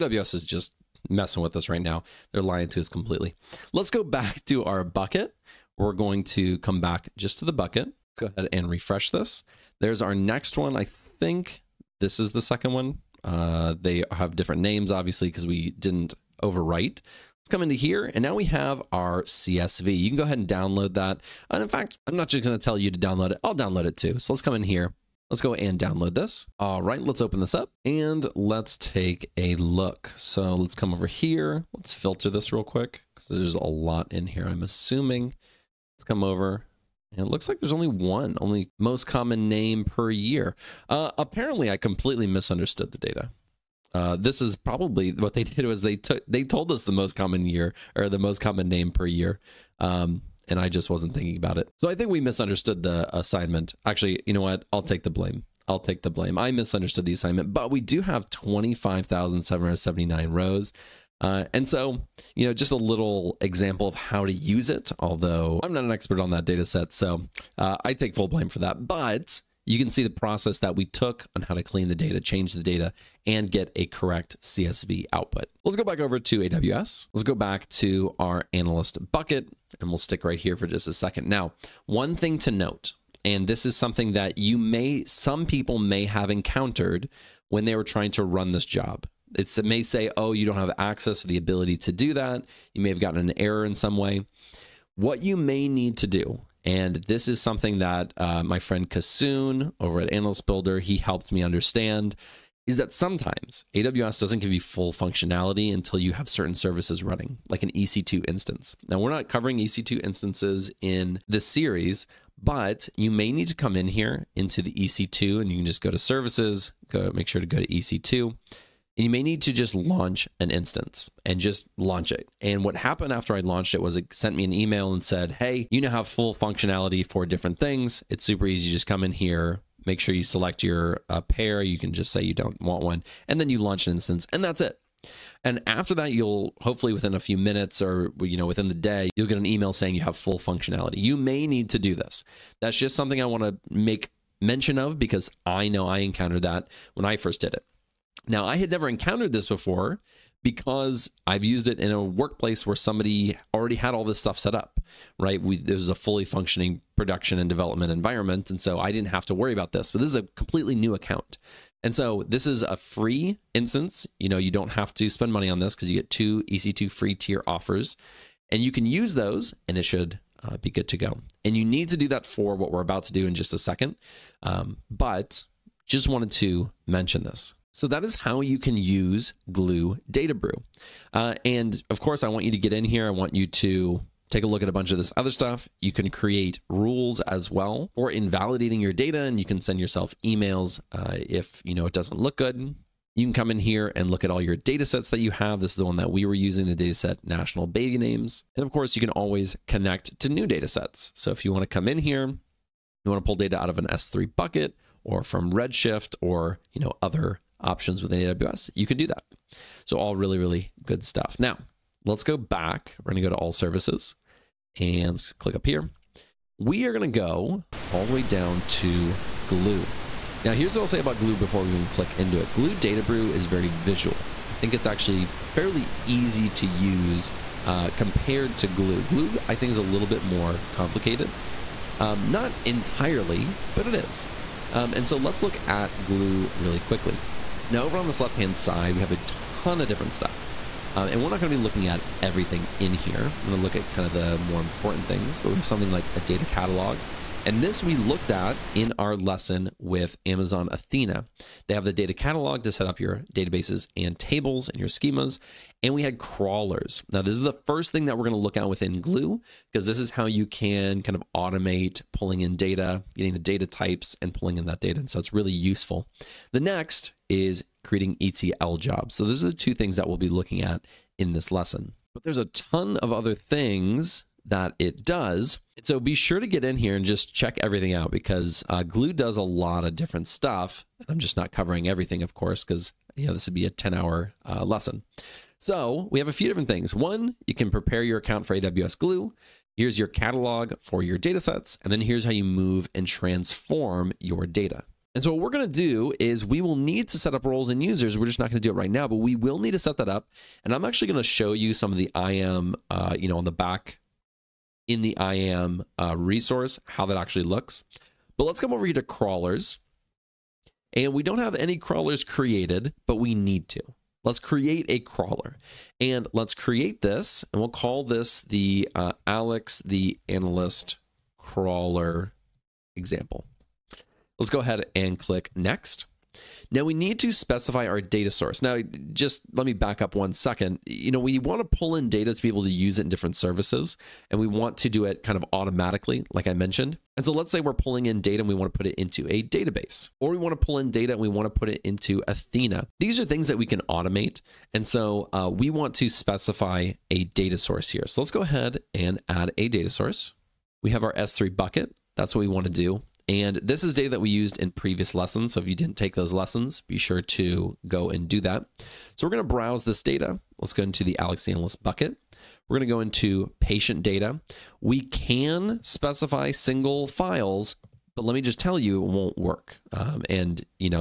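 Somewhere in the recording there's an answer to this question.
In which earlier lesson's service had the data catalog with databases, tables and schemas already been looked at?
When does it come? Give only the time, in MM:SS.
04:10.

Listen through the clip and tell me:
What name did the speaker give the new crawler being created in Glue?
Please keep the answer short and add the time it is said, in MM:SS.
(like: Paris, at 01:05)
Alex the Analyst crawler example, at 05:19.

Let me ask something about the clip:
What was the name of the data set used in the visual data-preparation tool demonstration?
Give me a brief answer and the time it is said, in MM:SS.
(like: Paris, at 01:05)
national baby names, at 03:17.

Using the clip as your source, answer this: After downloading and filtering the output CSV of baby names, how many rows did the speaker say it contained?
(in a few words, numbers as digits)
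25,779.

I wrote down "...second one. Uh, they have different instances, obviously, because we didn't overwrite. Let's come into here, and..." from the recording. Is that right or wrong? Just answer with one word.
wrong.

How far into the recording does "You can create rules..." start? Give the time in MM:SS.
03:05.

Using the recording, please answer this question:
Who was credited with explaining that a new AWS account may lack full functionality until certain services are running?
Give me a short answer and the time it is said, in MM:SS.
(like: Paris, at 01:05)
Kasoon, at 01:38.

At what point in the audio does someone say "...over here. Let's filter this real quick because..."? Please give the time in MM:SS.
00:30.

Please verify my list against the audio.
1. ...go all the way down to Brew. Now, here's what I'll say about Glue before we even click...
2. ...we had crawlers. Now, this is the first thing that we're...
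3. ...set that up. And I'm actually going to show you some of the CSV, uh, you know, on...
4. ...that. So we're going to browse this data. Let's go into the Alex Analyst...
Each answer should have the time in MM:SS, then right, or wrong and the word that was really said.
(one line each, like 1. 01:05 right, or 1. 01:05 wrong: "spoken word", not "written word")
1. 03:37 wrong: "Glue", not "Brew"
2. 04:15 right
3. 04:59 wrong: "IAM", not "CSV"
4. 05:58 right.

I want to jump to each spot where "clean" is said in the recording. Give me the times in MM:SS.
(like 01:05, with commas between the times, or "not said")
01:11.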